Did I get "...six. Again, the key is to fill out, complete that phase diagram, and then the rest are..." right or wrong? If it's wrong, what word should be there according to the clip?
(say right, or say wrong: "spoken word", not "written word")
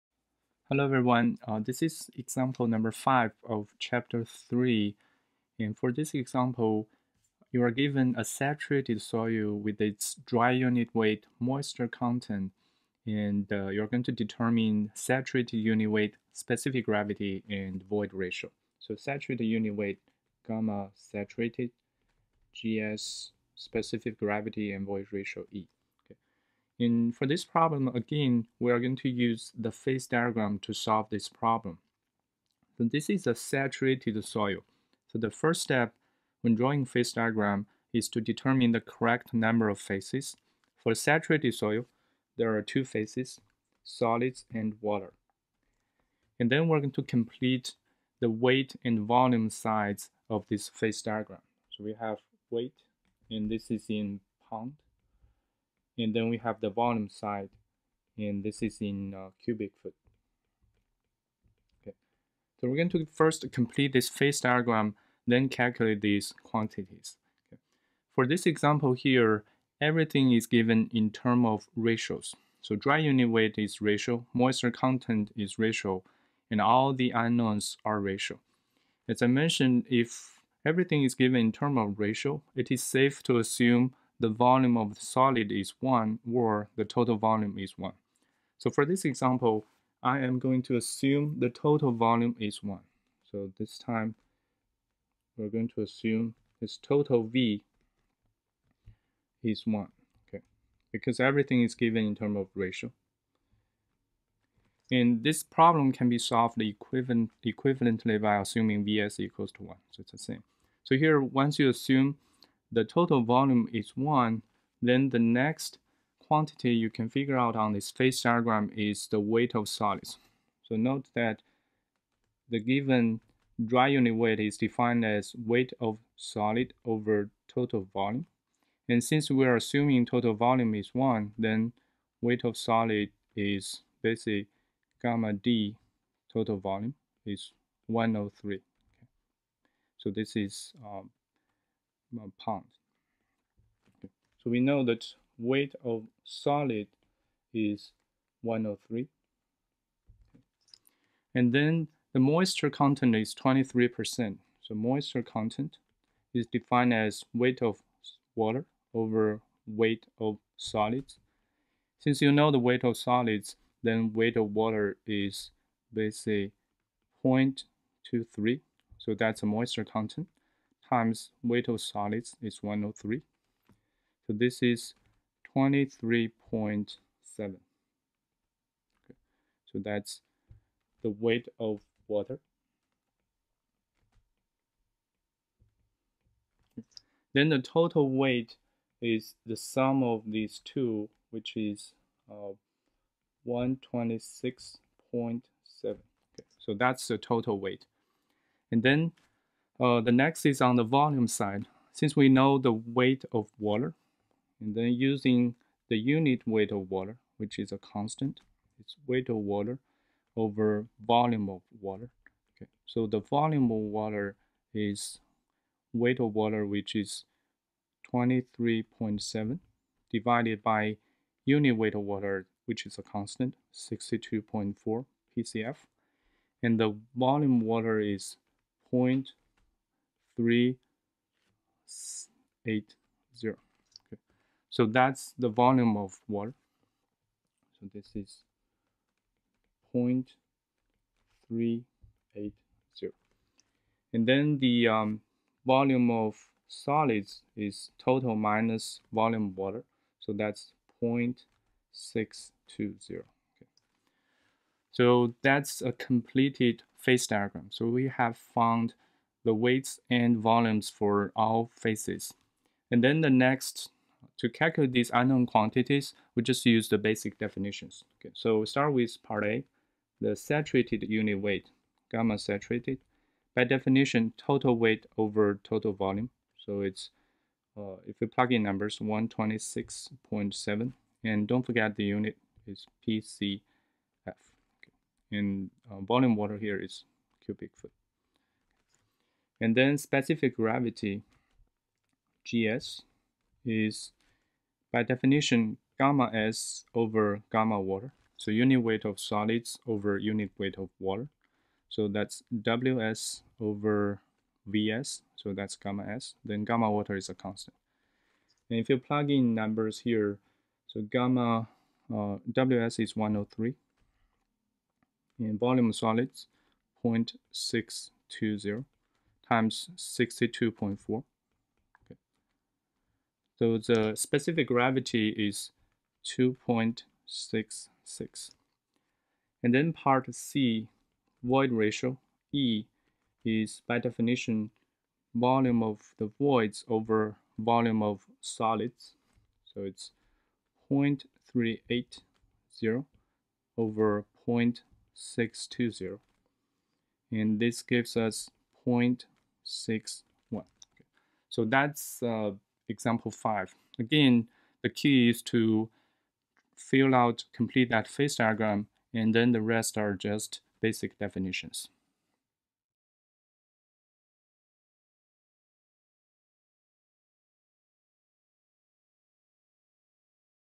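wrong: "five", not "six".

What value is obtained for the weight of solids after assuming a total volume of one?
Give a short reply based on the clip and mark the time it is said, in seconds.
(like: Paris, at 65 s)
103, at 136 s.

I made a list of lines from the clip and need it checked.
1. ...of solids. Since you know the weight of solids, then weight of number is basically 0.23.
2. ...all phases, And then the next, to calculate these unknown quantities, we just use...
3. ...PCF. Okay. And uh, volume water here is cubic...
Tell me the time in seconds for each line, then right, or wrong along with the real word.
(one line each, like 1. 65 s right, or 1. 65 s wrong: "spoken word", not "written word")
1. 160 s wrong: "water", not "number"
2. 261 s right
3. 283 s right.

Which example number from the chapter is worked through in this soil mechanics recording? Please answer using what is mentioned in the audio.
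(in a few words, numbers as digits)
5.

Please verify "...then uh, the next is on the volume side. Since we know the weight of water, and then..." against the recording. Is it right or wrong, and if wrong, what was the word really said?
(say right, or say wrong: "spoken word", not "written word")
right.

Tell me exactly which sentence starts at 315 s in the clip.
And volume of solids, 0.620 times 62.4.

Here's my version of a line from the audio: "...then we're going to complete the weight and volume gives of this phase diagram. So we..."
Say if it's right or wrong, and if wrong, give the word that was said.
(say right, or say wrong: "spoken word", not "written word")
wrong: "sides", not "gives".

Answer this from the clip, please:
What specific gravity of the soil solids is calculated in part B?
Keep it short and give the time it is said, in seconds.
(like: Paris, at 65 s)
2.66, at 326 s.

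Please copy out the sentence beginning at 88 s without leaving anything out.
So for this example, I am going to assume the total volume is 1.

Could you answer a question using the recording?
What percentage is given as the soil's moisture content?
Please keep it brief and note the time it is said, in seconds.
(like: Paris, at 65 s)
23%, at 153 s.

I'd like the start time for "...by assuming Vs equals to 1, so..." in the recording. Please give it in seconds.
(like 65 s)
108 s.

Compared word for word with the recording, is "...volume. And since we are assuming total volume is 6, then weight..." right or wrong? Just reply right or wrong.
wrong.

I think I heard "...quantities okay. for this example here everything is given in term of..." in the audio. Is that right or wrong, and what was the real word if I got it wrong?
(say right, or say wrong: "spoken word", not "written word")
right.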